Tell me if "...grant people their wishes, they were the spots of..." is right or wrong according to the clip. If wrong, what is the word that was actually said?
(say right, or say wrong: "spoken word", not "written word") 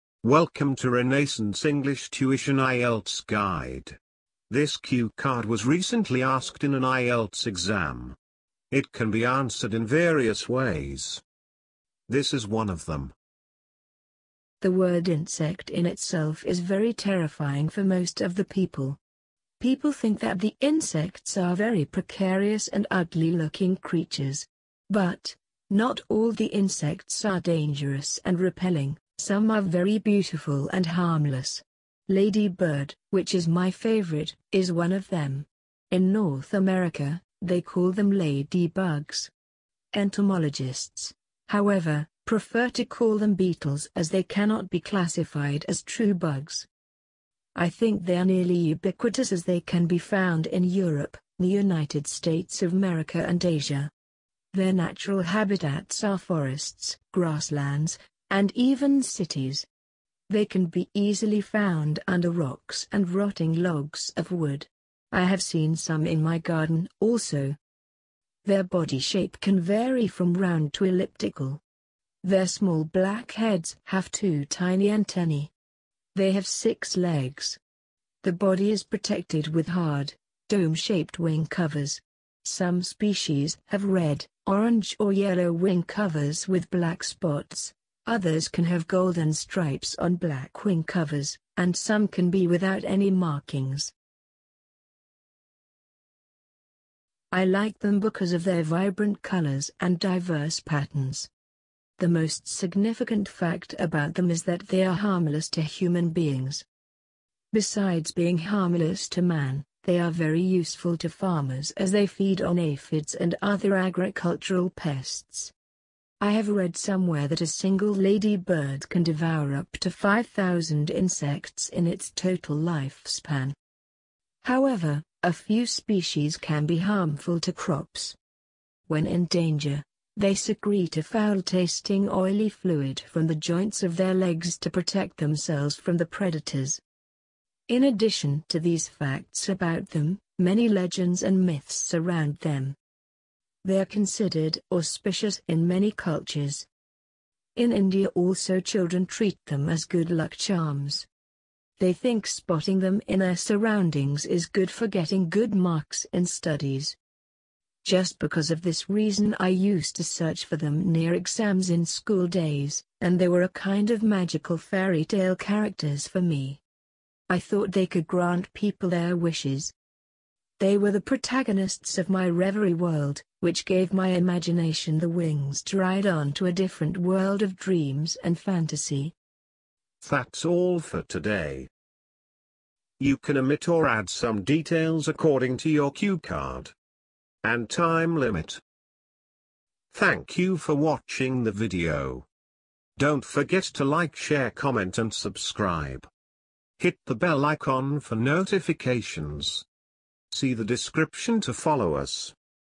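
wrong: "protagonists", not "spots".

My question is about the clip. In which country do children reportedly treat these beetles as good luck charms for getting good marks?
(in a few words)
India.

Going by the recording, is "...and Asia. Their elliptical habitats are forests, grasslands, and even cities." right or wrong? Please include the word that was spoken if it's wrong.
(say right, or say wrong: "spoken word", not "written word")
wrong: "natural", not "elliptical".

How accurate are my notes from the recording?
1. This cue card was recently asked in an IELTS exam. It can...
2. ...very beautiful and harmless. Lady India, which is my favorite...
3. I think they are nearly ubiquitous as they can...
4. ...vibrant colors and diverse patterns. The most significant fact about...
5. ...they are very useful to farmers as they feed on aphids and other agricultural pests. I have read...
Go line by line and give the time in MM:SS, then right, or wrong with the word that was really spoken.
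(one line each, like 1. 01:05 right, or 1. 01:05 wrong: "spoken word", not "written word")
1. 00:04 right
2. 00:29 wrong: "Bird", not "India"
3. 00:47 right
4. 01:38 right
5. 01:49 right.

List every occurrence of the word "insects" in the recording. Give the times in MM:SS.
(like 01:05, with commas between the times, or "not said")
00:15, 00:20, 00:26, 02:00.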